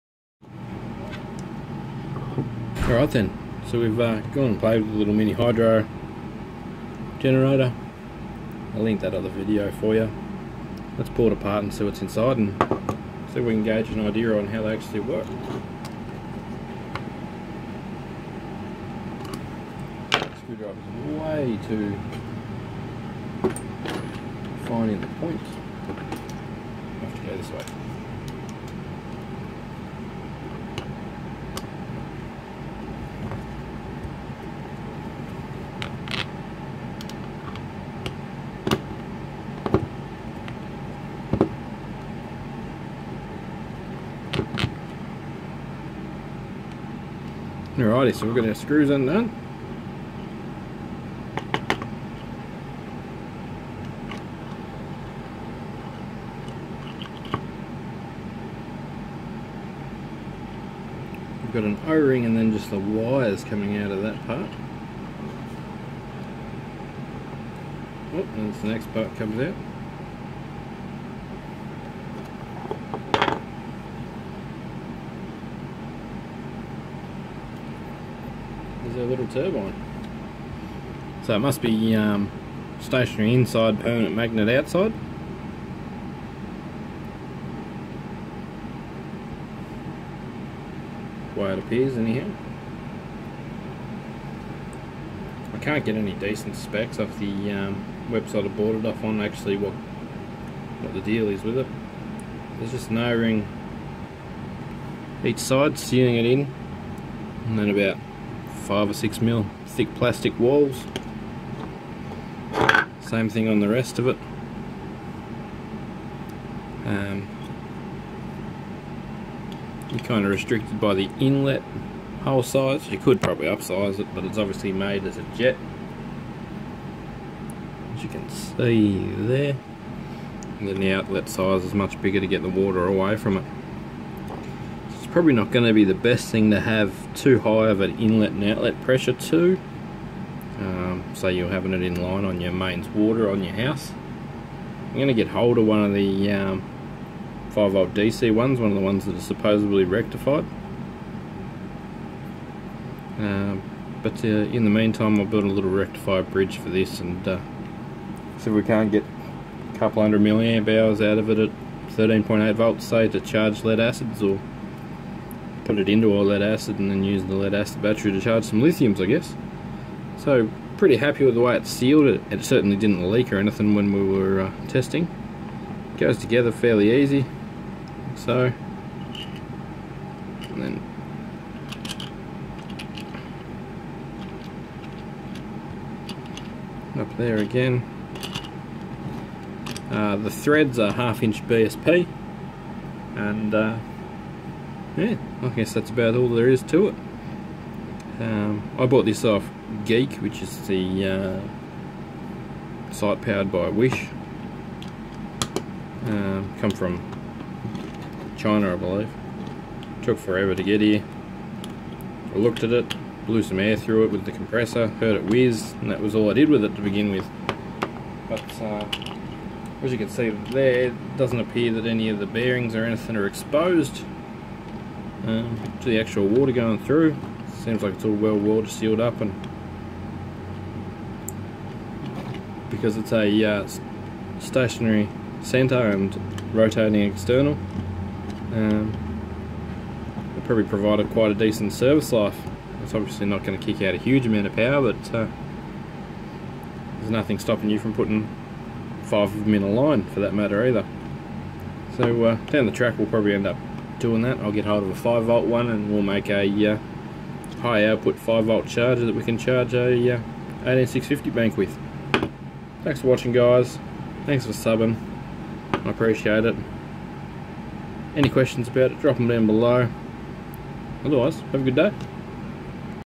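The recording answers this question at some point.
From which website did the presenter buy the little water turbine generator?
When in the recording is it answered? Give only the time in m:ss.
3:19.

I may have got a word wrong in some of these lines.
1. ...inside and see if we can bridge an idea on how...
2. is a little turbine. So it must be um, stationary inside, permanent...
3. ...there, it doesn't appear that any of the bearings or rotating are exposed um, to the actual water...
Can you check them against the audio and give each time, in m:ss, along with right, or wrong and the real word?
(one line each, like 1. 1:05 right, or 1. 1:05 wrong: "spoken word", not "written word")
1. 0:12 wrong: "gauge", not "bridge"
2. 1:18 right
3. 3:40 wrong: "anything", not "rotating".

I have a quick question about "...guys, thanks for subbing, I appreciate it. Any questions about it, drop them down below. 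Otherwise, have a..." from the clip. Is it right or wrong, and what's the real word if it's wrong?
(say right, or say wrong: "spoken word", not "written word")
right.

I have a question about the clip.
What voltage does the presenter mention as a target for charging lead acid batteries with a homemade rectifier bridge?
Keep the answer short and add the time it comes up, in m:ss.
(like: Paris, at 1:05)
13.8 volts, at 2:41.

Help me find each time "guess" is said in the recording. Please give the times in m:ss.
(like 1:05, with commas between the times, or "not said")
2:49, 3:15.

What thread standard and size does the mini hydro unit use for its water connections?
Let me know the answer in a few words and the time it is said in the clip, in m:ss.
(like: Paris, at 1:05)
Half inch BSP, at 3:10.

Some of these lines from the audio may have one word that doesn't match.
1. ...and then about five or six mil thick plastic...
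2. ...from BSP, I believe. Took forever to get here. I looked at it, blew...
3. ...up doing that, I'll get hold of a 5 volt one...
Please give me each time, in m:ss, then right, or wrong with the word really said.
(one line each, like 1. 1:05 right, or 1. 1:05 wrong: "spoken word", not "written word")
1. 1:47 right
2. 3:26 wrong: "China", not "BSP"
3. 4:13 right.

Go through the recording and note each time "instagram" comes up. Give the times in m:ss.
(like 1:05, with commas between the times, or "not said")
not said.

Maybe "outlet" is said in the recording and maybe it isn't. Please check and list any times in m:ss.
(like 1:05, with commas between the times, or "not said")
2:10, 2:18.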